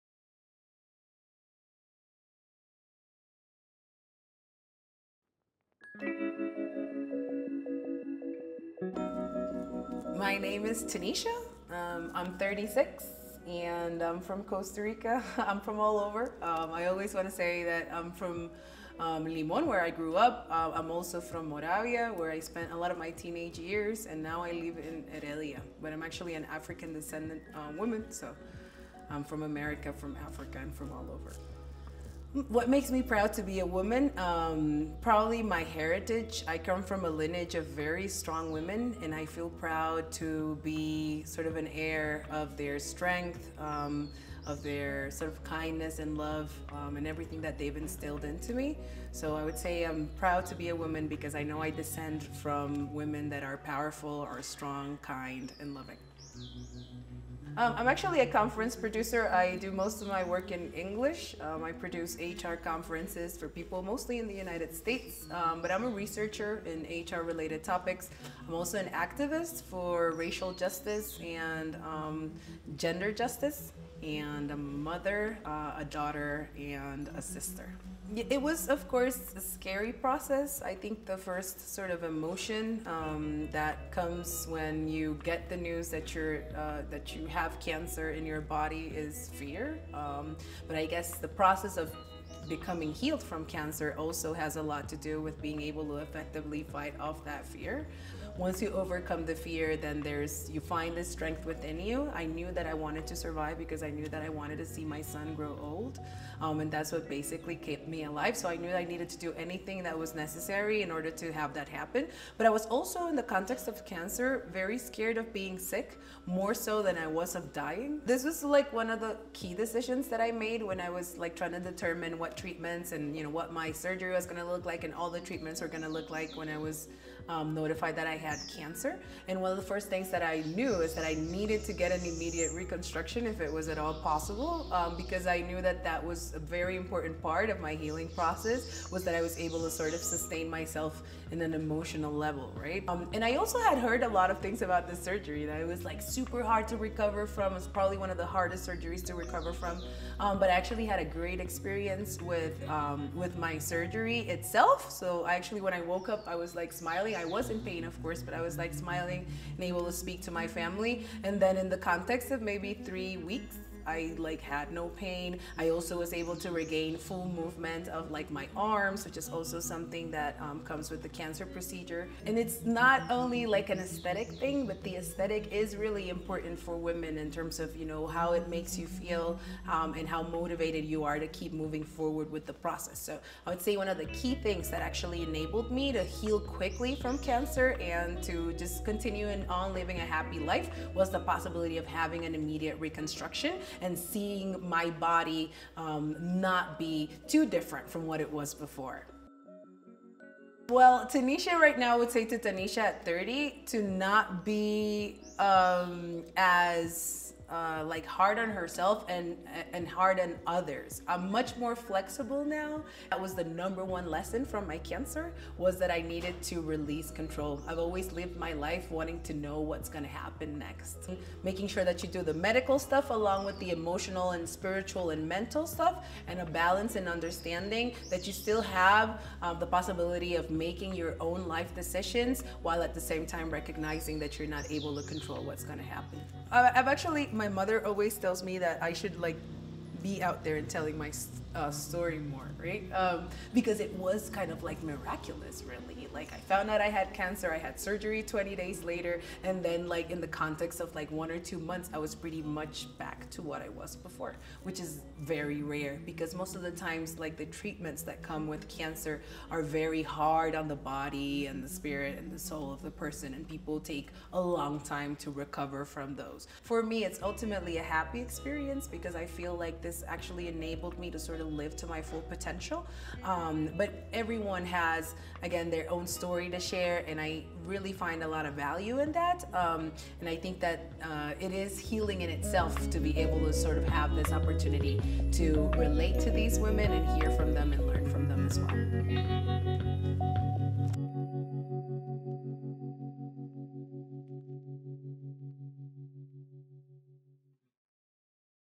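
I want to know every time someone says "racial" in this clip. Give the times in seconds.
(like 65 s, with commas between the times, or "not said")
70 s.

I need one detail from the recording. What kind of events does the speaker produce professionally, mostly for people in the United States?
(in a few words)
HR conferences.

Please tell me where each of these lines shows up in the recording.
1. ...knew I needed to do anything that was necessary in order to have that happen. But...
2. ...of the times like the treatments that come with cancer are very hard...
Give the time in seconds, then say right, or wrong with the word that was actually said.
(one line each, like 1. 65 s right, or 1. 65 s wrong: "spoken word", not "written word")
1. 108 s right
2. 256 s right.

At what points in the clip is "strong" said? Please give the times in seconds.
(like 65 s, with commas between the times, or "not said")
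38 s, 54 s.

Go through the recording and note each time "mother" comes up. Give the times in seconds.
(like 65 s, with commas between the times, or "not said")
74 s, 237 s.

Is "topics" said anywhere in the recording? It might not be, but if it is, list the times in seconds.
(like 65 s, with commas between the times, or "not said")
67 s.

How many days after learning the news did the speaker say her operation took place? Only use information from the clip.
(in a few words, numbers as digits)
20 days.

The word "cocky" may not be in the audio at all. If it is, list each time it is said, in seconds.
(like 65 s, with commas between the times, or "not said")
not said.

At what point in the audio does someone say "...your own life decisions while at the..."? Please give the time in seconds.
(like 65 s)
230 s.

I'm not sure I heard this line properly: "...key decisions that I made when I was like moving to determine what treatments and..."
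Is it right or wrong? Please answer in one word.
wrong.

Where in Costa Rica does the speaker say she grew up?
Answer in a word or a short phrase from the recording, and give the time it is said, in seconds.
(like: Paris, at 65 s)
Limon, at 19 s.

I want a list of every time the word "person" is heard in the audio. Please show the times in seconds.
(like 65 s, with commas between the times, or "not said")
262 s.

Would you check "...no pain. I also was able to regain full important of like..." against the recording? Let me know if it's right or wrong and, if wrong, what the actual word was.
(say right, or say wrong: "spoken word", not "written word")
wrong: "movement", not "important".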